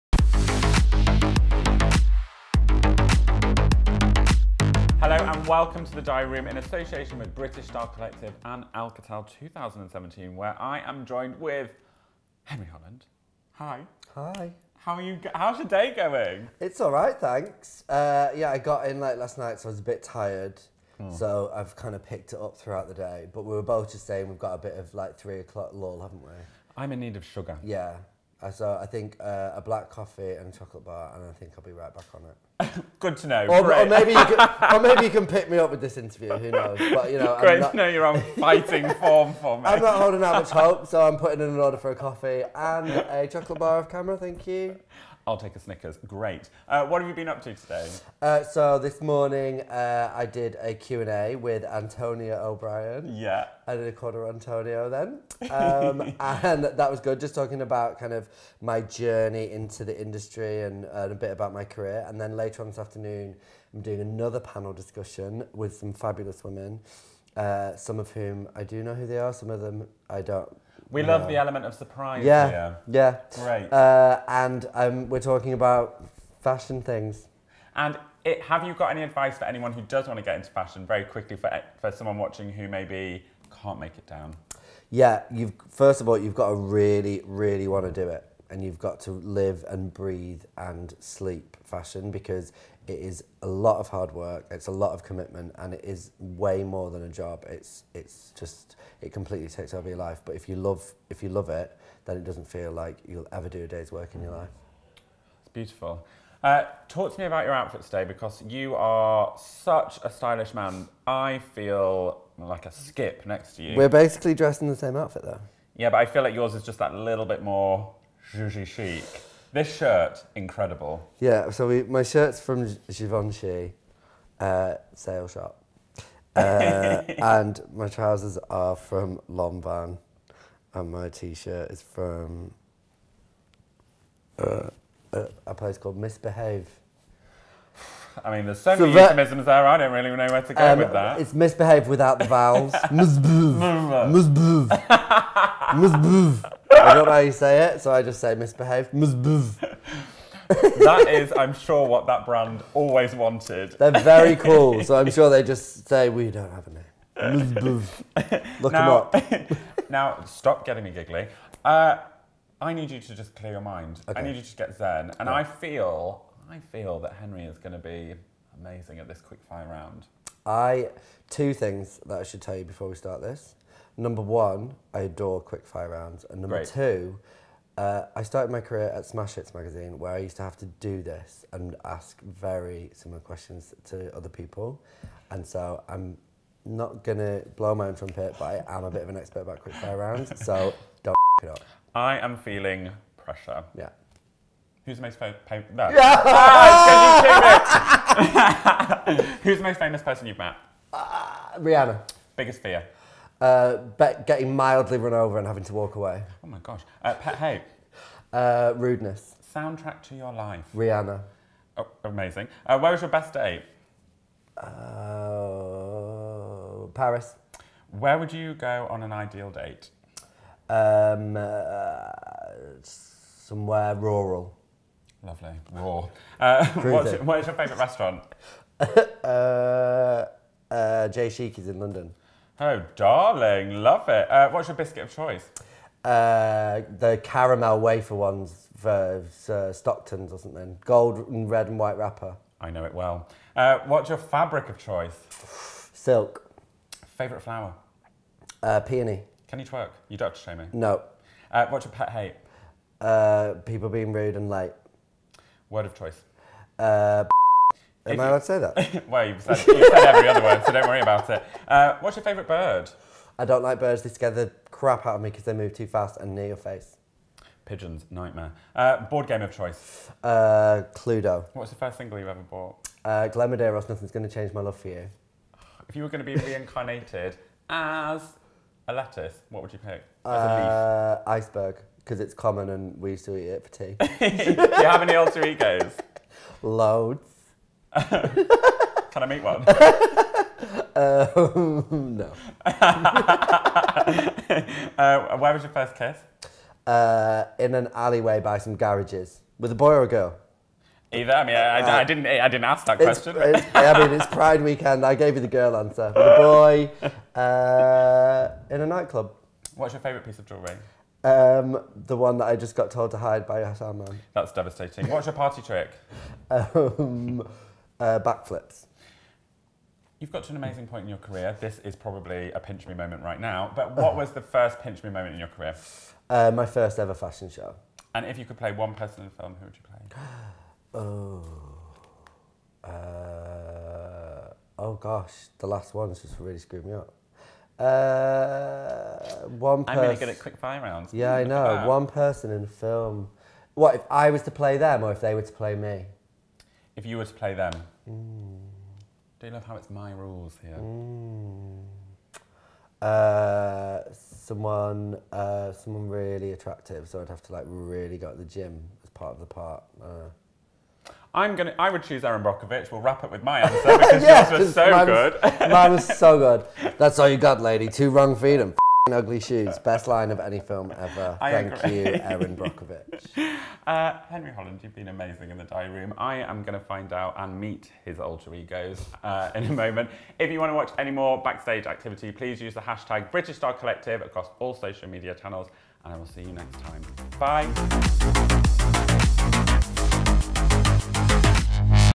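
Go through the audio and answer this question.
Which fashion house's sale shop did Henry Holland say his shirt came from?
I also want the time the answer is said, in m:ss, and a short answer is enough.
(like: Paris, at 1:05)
Givenchy, at 2:02.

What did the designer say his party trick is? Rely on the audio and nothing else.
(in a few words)
Backflips.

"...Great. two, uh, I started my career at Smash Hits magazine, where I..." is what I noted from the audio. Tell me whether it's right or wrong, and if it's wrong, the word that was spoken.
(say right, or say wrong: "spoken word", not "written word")
right.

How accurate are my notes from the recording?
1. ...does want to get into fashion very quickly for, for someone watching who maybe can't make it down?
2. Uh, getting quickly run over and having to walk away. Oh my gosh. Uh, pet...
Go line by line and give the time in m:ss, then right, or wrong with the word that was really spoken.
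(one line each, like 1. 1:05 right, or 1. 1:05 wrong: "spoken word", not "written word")
1. 1:19 right
2. 3:23 wrong: "mildly", not "quickly".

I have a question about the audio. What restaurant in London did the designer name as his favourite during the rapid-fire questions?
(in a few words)
J Sheekey's.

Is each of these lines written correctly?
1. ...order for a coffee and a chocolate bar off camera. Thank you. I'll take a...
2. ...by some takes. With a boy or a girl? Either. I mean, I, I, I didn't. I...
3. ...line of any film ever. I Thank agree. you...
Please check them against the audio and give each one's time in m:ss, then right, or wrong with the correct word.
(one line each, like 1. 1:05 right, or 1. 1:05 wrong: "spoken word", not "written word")
1. 0:41 right
2. 4:58 wrong: "garages", not "takes"
3. 6:10 right.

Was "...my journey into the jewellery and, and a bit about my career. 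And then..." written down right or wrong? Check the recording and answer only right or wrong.
wrong.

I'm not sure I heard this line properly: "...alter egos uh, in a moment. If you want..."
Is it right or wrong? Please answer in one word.
right.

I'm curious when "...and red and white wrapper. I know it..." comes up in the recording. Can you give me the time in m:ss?
4:01.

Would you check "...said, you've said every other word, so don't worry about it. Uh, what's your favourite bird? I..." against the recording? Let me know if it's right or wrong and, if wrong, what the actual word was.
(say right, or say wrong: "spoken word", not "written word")
right.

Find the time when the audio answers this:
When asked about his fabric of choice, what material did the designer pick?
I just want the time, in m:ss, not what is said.
4:05.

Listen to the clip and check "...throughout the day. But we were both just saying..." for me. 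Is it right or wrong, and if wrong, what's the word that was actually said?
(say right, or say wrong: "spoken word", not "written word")
right.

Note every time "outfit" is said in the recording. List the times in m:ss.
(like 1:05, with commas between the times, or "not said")
1:47, 1:54.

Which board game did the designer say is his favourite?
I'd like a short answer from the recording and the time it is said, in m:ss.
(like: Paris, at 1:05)
Cluedo, at 4:30.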